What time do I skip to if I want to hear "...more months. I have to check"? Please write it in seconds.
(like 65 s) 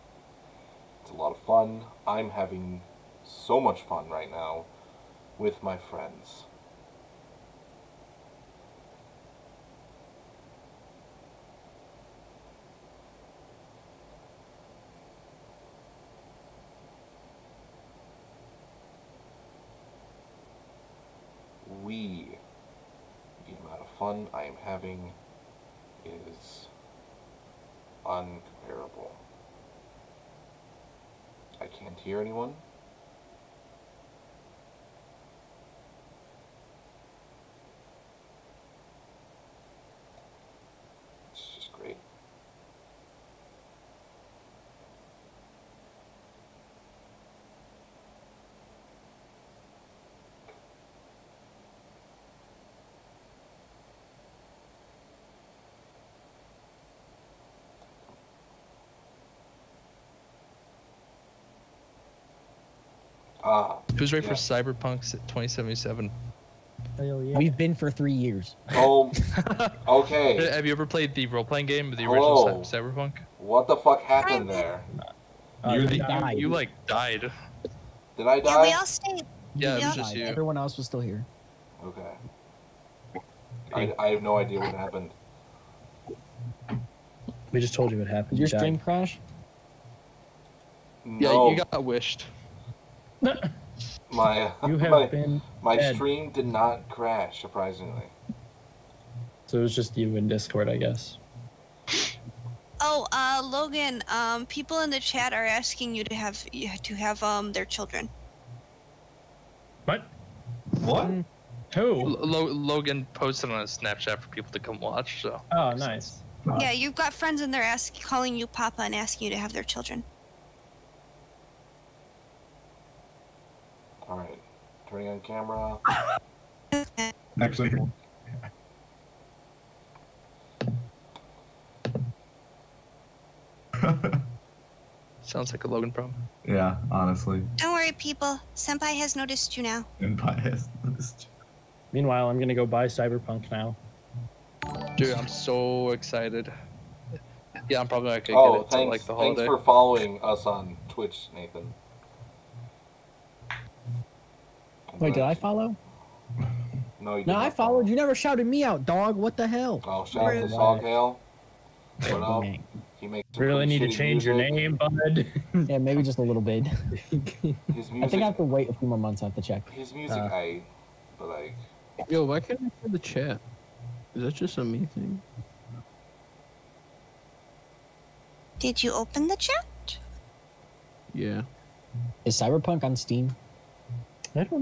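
168 s.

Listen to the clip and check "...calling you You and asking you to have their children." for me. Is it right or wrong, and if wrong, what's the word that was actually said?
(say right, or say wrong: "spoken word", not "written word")
wrong: "Papa", not "You".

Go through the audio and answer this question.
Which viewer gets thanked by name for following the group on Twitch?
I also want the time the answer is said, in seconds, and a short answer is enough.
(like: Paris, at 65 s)
Nathan, at 151 s.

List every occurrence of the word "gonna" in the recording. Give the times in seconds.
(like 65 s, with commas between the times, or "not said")
142 s, 148 s.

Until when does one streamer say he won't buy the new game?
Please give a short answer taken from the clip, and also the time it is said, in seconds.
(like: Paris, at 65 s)
The holiday, at 149 s.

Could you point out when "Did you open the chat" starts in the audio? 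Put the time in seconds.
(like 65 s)
178 s.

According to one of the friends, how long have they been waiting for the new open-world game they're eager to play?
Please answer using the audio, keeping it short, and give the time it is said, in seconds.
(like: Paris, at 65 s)
3 years, at 67 s.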